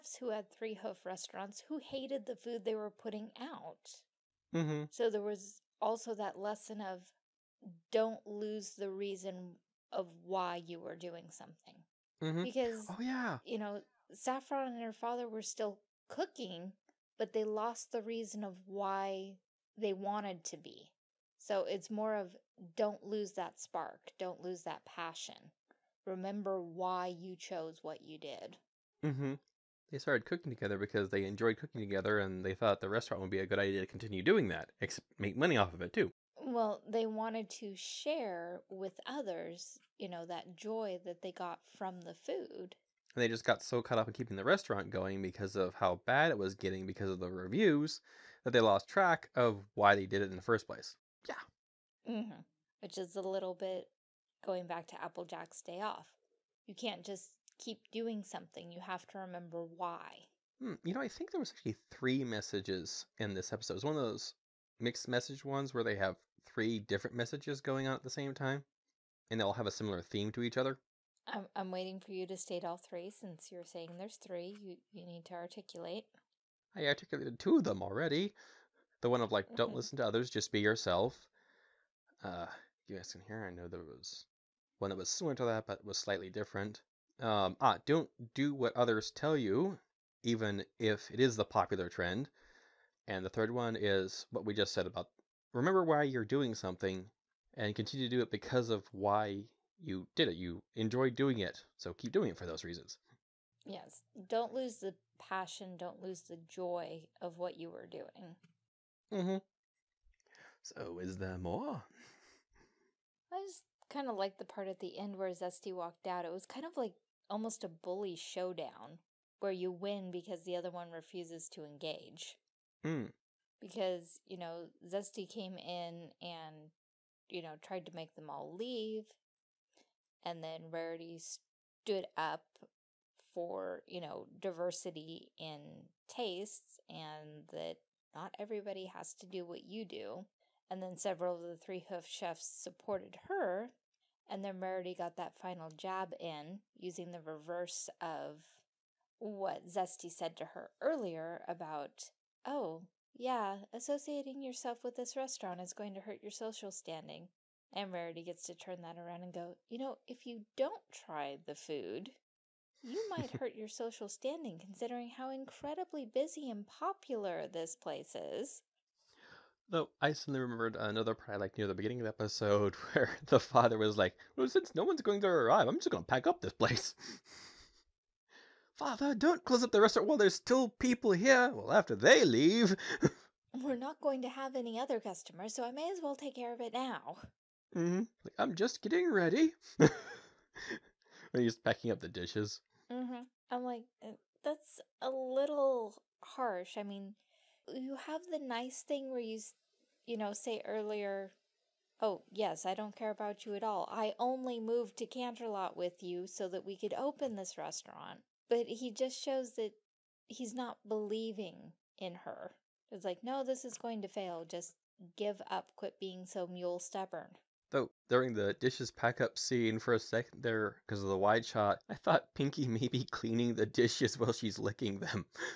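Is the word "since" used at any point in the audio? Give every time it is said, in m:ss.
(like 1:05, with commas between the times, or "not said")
1:13, 2:54.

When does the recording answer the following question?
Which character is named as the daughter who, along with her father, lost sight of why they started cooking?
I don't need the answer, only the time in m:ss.
0:14.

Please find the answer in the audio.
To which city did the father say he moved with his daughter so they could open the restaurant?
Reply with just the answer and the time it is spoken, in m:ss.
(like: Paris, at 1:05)
Canterlot, at 3:25.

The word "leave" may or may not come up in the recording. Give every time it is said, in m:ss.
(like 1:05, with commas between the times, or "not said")
2:08, 3:02.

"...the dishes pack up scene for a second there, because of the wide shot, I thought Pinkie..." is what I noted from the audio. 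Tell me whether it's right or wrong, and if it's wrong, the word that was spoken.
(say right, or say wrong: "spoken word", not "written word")
right.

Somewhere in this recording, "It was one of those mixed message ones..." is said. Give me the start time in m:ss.
1:03.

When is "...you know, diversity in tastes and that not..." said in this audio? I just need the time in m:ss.
2:13.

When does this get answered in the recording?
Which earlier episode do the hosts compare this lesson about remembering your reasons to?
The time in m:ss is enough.
0:55.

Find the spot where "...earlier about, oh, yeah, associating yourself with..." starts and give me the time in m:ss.
2:30.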